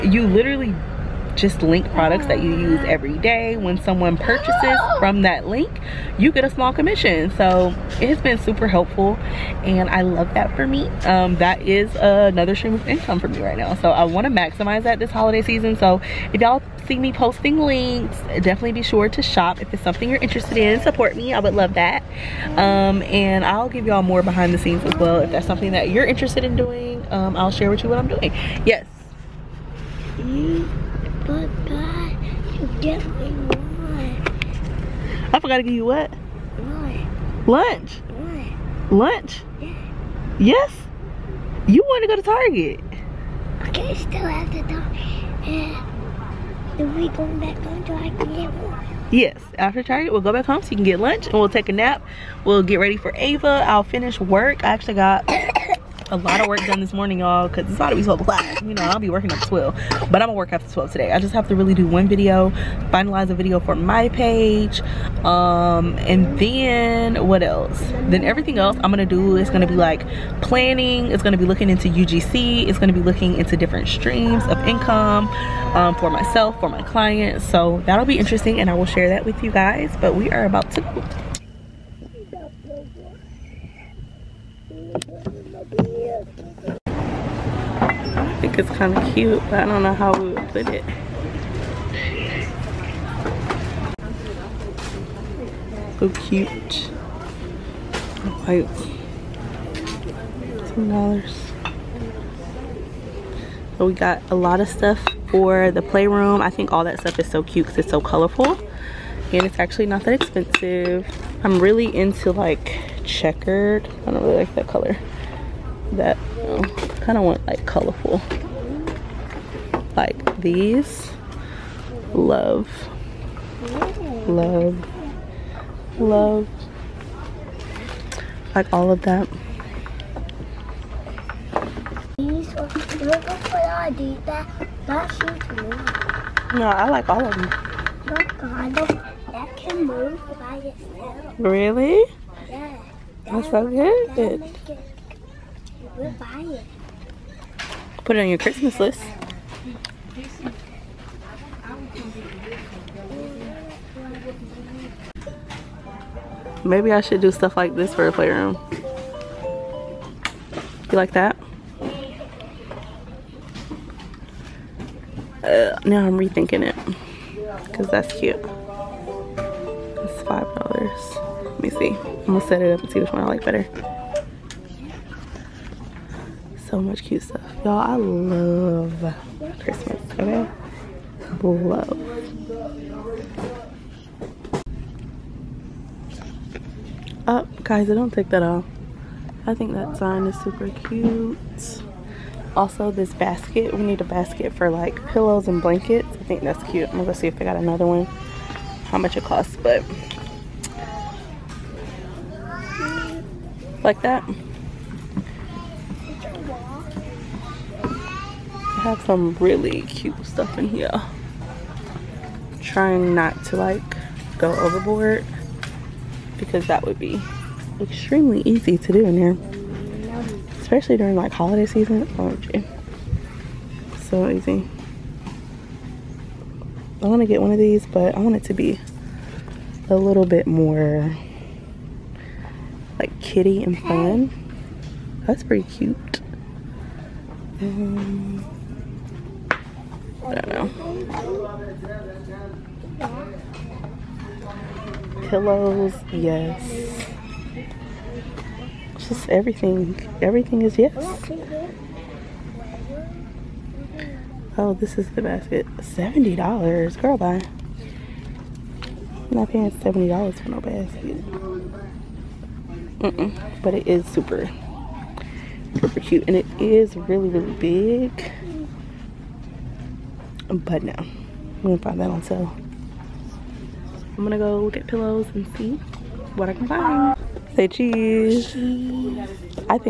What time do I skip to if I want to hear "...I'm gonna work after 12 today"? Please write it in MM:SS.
01:00.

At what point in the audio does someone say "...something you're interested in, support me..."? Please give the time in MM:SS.
00:19.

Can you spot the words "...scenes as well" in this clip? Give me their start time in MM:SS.
00:24.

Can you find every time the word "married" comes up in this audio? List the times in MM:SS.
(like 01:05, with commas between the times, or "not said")
not said.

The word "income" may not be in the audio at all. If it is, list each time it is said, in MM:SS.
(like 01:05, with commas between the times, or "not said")
00:12, 01:14.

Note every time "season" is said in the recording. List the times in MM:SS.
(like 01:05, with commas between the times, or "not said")
00:15, 03:41.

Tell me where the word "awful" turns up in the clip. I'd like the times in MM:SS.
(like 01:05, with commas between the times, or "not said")
not said.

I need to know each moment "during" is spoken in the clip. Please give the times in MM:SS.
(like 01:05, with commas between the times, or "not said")
03:40.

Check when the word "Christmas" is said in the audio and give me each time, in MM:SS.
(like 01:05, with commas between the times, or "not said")
02:28, 02:59.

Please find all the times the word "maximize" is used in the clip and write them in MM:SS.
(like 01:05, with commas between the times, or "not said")
00:14.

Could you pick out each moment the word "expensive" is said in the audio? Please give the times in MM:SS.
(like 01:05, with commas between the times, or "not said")
01:50.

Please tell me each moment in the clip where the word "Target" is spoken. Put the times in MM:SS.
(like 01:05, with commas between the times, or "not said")
00:42, 00:49.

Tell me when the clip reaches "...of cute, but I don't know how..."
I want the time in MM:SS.
01:28.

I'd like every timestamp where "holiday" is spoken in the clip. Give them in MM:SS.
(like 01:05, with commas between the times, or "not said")
00:15, 03:41.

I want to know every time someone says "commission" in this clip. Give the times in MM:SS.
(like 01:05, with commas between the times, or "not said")
00:06.